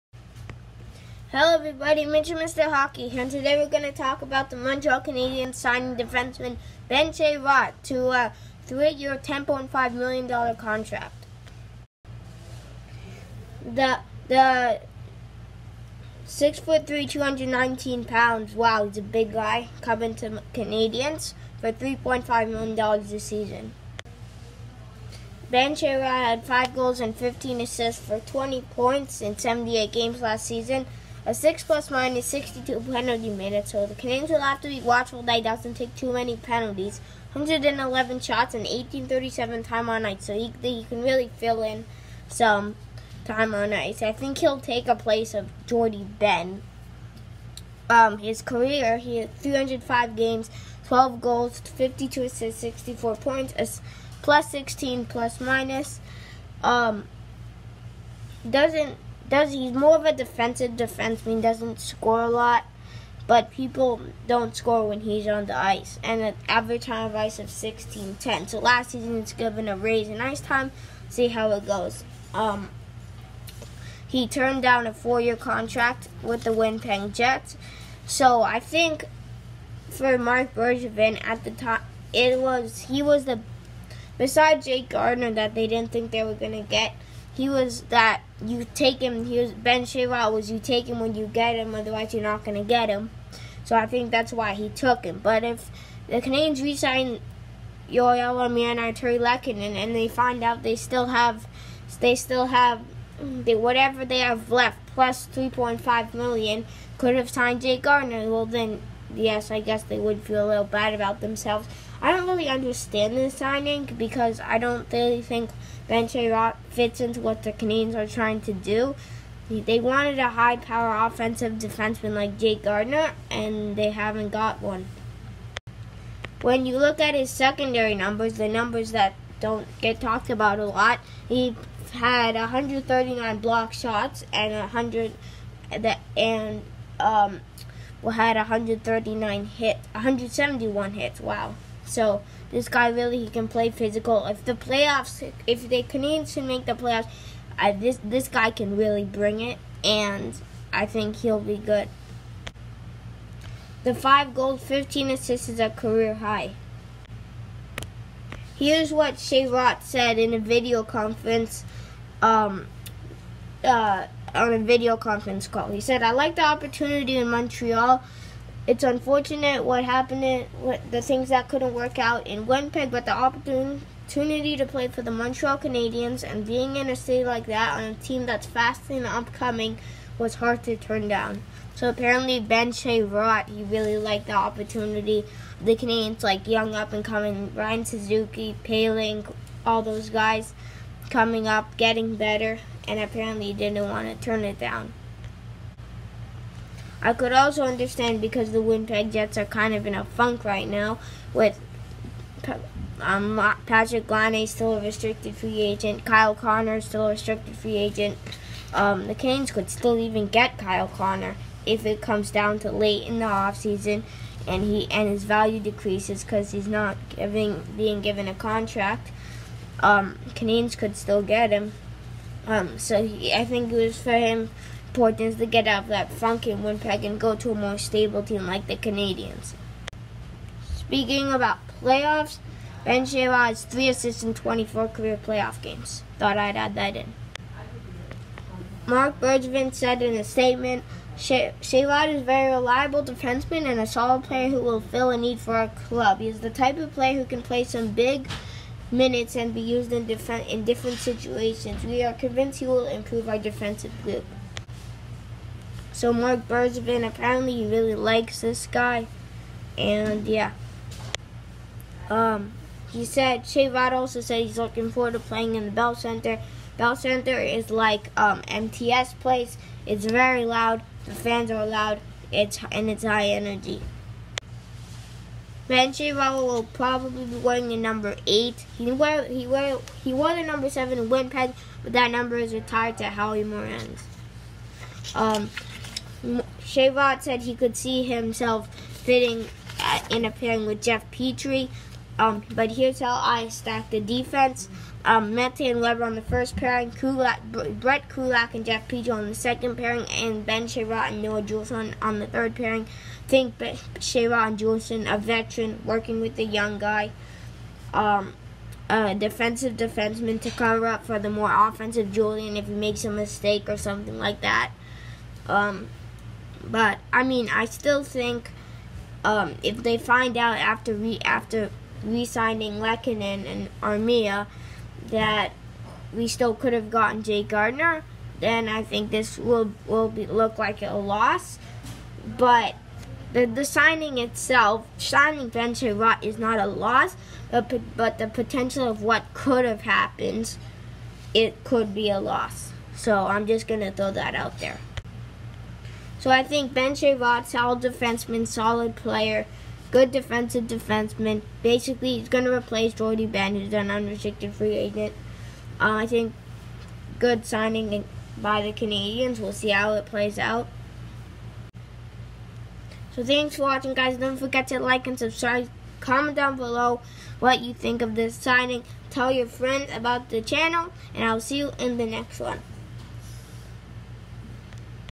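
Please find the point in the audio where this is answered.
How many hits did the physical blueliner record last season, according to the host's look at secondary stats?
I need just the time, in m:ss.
2:19.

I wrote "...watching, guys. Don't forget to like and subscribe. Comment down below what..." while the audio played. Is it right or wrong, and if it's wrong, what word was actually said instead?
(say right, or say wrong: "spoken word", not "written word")
right.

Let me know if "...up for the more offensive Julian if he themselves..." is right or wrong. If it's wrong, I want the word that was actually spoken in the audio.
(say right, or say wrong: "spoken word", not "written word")
wrong: "makes", not "themselves".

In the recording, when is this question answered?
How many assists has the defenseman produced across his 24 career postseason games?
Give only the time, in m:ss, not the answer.
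3:53.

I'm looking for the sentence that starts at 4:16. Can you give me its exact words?
So Marc Bergevin apparently really likes this guy, and yeah.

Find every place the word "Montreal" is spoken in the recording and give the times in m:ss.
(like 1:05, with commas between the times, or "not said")
0:04, 2:47, 2:55.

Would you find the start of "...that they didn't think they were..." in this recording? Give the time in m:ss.
1:25.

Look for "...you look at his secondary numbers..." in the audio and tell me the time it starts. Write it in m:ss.
2:06.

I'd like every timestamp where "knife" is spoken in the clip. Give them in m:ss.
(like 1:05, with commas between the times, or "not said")
not said.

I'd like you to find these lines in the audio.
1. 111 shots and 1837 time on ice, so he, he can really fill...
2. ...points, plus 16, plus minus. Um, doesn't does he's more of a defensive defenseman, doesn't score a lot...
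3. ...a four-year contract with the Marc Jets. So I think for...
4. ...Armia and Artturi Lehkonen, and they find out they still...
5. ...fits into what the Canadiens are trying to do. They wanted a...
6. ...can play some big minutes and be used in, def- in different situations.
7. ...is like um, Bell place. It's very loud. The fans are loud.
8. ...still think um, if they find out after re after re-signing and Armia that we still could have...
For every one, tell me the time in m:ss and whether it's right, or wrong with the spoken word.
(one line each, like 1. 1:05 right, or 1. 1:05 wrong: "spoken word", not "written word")
1. 0:37 right
2. 0:53 right
3. 1:14 wrong: "Winnipeg", not "Marc"
4. 1:38 right
5. 1:56 right
6. 4:07 right
7. 4:27 wrong: "MTS", not "Bell"
8. 5:17 right.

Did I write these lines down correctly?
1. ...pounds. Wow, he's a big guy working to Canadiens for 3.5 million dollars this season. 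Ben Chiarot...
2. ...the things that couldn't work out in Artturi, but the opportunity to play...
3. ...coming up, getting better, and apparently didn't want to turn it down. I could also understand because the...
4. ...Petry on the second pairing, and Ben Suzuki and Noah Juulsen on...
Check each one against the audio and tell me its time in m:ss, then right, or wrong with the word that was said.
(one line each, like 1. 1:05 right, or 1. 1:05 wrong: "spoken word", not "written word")
1. 0:18 wrong: "coming", not "working"
2. 2:50 wrong: "Winnipeg", not "Artturi"
3. 3:11 right
4. 4:58 wrong: "Chiarot", not "Suzuki".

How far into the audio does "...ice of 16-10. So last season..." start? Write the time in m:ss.
1:07.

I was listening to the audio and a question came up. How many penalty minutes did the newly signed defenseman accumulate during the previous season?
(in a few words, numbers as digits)
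62.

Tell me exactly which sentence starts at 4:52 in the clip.
Um, but here's how I stack the defense.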